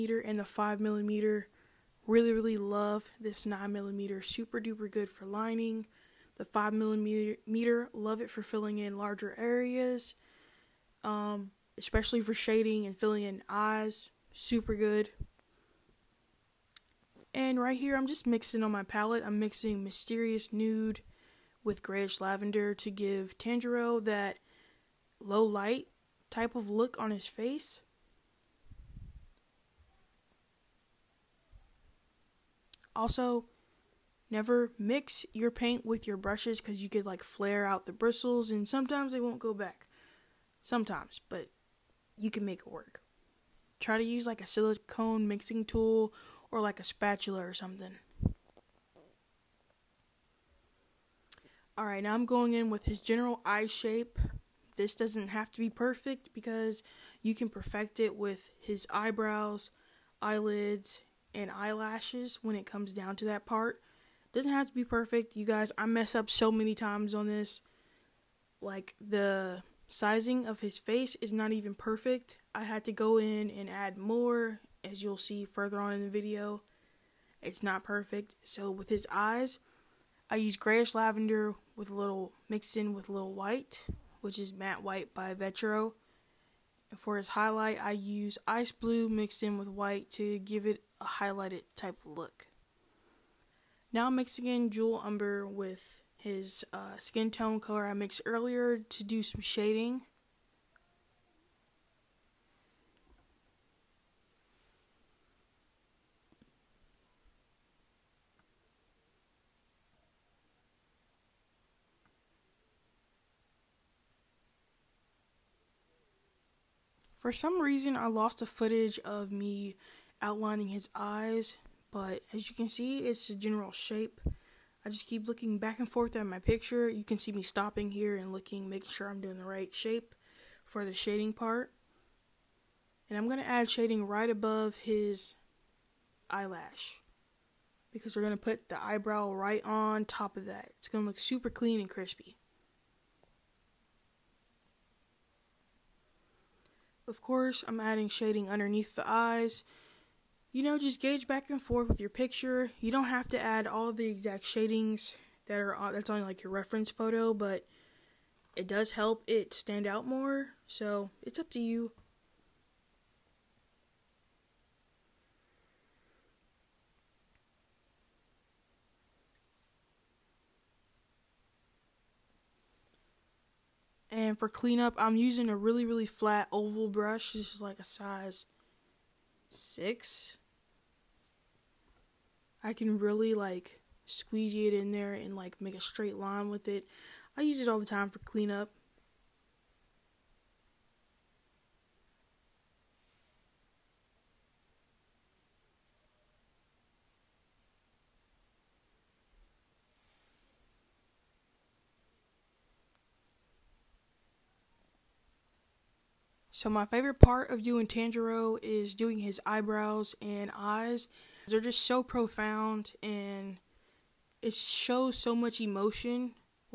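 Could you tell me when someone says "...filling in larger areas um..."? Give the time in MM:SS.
00:08.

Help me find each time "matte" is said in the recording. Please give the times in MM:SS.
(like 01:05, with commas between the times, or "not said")
01:24.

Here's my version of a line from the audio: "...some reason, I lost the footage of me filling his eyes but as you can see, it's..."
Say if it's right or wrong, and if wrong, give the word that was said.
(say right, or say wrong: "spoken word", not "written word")
wrong: "outlining", not "filling".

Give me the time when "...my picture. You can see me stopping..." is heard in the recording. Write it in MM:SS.
02:06.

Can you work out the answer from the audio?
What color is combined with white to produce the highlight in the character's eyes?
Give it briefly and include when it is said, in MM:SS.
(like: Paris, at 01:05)
Ice blue, at 01:28.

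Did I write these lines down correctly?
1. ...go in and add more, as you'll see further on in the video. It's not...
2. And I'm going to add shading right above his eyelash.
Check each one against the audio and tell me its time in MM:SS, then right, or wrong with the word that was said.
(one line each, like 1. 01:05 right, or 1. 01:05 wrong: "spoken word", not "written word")
1. 01:12 right
2. 02:13 right.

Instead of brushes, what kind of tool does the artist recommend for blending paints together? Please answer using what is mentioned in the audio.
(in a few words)
Silicone mixing tool.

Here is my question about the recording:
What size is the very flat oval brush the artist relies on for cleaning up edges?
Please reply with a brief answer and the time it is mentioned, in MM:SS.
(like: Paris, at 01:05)
6, at 02:57.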